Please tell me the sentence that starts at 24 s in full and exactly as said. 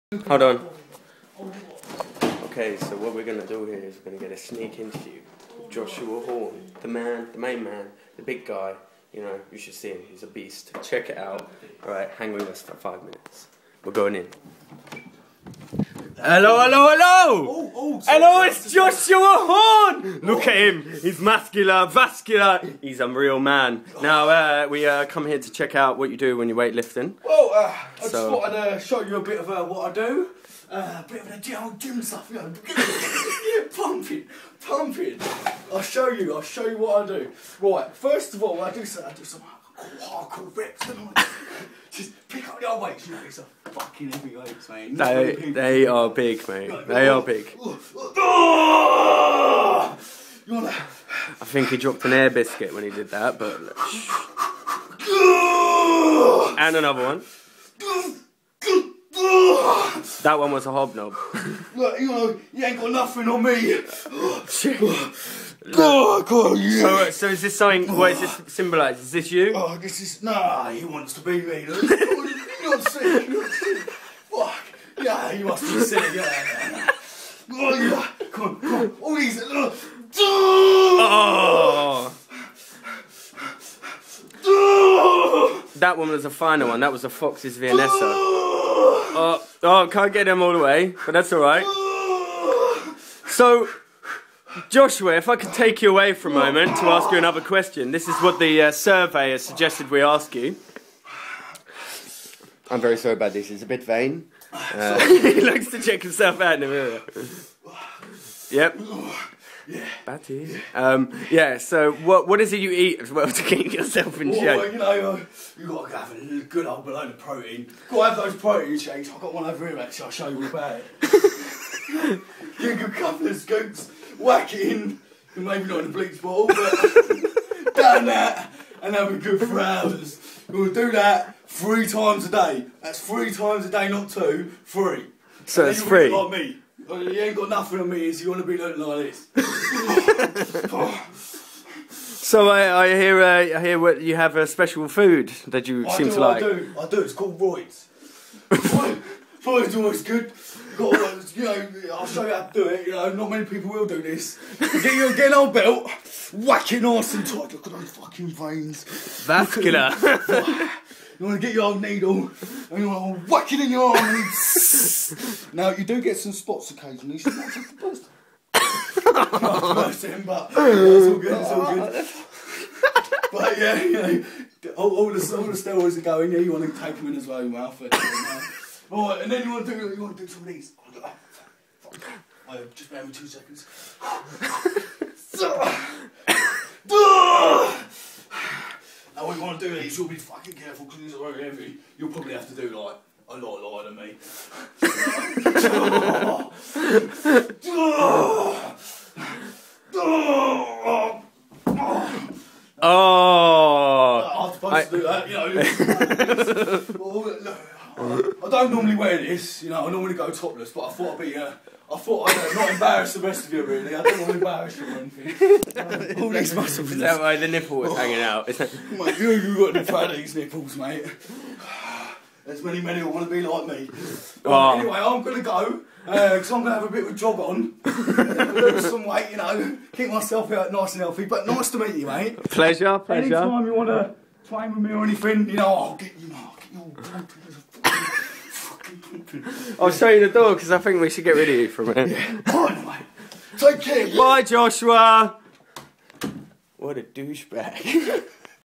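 Now, uh, we uh, come here to check out what you do when you're weightlifting.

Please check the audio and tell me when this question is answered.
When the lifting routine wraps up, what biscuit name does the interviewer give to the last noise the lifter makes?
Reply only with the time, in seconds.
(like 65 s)
87 s.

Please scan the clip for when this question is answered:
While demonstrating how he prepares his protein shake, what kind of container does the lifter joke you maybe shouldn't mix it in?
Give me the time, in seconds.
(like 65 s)
125 s.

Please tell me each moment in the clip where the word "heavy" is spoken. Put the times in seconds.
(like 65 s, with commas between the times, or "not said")
44 s, 191 s.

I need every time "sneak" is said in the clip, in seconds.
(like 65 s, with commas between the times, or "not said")
4 s.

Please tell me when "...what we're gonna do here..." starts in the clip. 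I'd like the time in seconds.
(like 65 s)
2 s.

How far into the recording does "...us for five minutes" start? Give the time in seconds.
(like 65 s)
12 s.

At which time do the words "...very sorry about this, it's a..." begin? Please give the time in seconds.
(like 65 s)
102 s.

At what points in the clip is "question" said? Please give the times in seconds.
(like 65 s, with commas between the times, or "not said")
97 s.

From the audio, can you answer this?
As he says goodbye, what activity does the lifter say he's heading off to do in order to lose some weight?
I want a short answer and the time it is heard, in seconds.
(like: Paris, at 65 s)
Jog, at 227 s.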